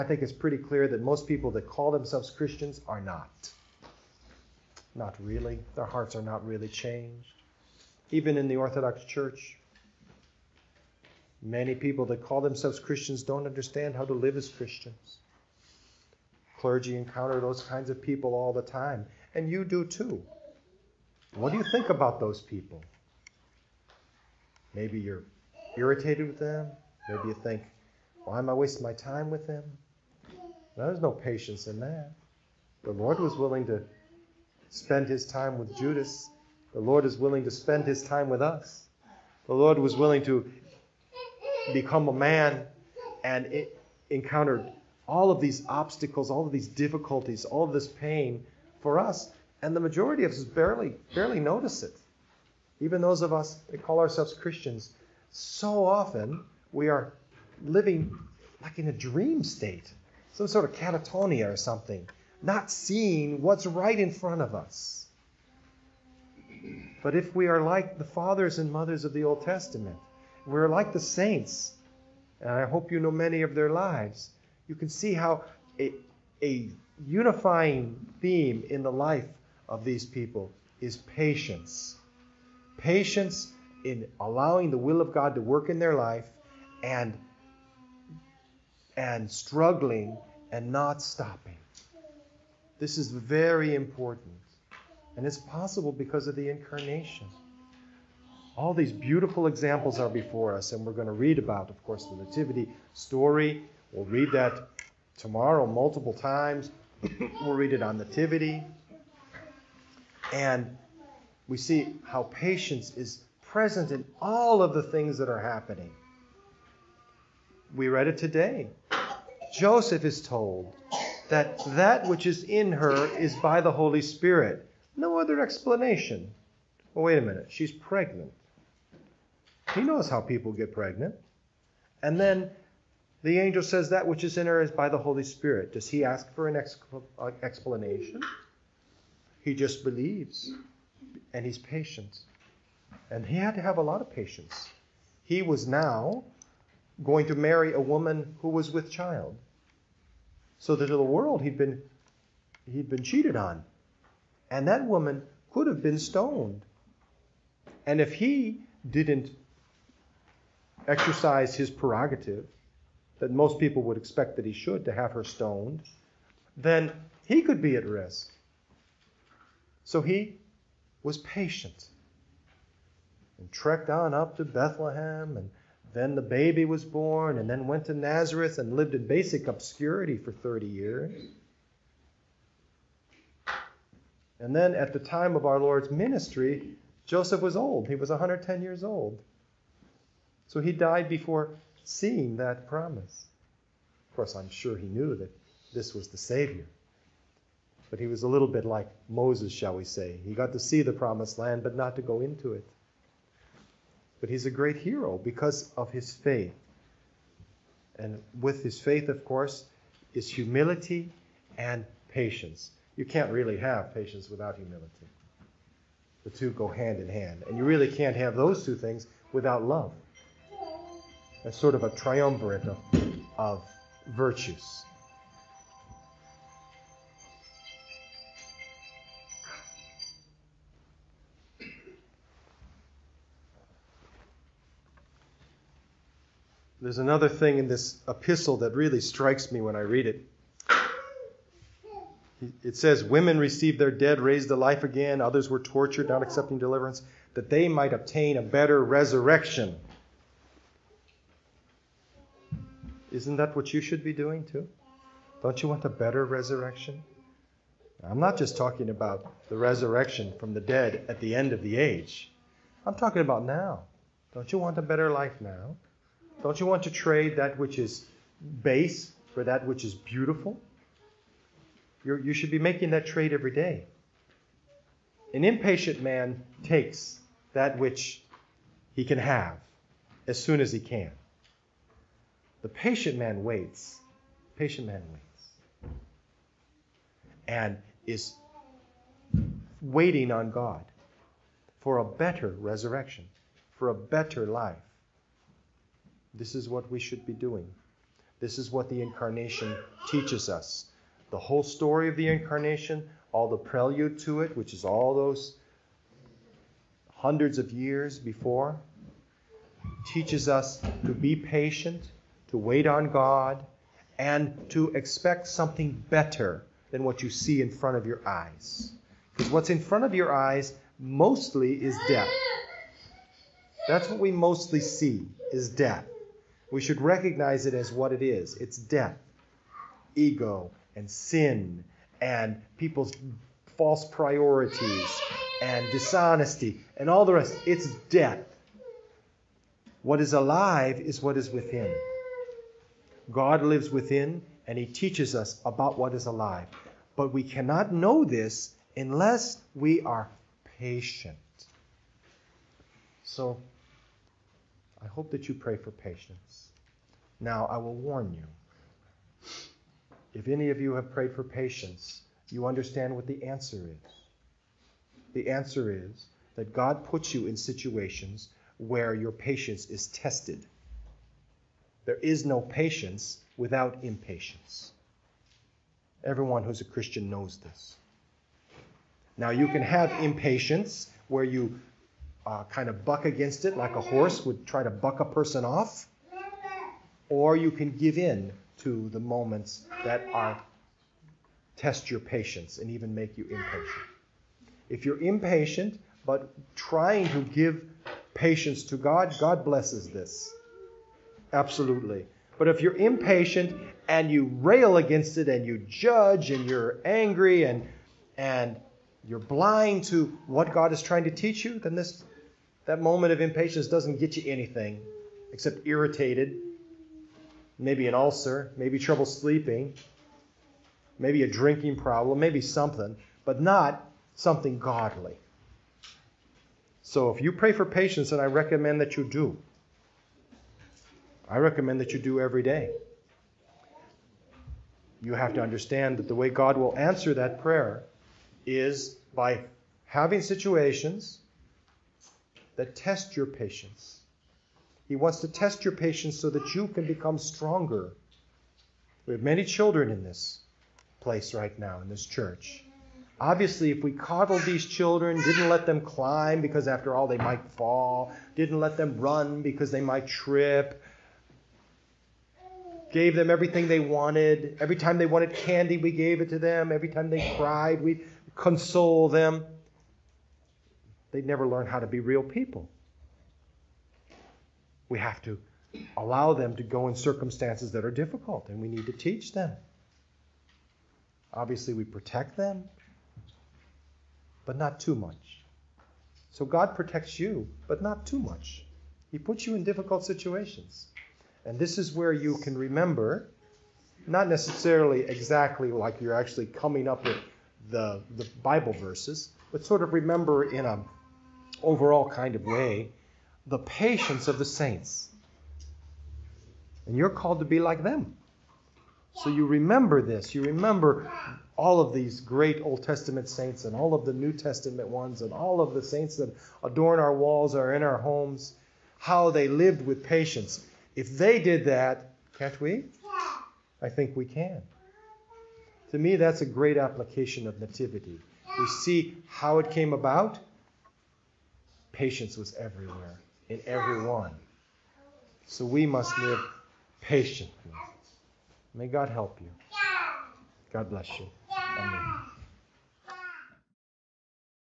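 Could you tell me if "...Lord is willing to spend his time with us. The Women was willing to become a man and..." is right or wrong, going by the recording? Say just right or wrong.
wrong.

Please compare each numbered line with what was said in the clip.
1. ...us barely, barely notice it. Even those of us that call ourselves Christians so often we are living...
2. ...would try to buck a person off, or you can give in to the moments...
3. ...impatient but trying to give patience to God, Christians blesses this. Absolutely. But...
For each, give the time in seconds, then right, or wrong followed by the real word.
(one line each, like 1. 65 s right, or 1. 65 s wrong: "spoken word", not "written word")
1. 50 s right
2. 384 s right
3. 395 s wrong: "God", not "Christians".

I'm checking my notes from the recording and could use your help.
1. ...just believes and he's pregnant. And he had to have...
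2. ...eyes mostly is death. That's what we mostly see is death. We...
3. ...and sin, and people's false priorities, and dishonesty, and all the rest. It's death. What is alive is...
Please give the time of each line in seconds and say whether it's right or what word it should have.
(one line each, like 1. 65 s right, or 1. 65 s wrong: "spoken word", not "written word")
1. 139 s wrong: "patient", not "pregnant"
2. 320 s right
3. 330 s right.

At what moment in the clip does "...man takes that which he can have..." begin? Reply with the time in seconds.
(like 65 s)
276 s.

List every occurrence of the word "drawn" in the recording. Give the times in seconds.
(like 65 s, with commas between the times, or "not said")
not said.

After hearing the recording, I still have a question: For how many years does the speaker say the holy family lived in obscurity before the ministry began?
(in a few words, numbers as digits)
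30.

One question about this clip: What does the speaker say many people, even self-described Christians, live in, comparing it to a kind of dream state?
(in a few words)
catatonia.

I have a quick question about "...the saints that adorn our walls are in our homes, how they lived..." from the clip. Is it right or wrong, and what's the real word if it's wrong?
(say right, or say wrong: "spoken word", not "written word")
right.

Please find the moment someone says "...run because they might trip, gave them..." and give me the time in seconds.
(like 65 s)
459 s.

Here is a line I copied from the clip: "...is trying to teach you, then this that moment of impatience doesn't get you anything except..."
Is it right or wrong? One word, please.
right.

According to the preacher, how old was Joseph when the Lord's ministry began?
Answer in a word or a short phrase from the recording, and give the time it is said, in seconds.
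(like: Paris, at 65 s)
110, at 188 s.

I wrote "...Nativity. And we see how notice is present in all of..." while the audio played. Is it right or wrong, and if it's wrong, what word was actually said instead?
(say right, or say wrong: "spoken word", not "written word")
wrong: "patience", not "notice".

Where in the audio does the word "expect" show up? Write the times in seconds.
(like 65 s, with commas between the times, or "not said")
163 s, 314 s.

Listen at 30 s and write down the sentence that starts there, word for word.
Now, there's no patience in that.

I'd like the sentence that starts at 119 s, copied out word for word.
Joseph is told that that which is in her is by the Holy Spirit.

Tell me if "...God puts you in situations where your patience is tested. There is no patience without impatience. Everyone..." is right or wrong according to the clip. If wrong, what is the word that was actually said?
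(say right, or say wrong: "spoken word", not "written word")
right.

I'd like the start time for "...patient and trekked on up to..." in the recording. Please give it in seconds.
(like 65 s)
171 s.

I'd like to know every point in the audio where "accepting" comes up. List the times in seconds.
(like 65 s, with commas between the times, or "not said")
246 s.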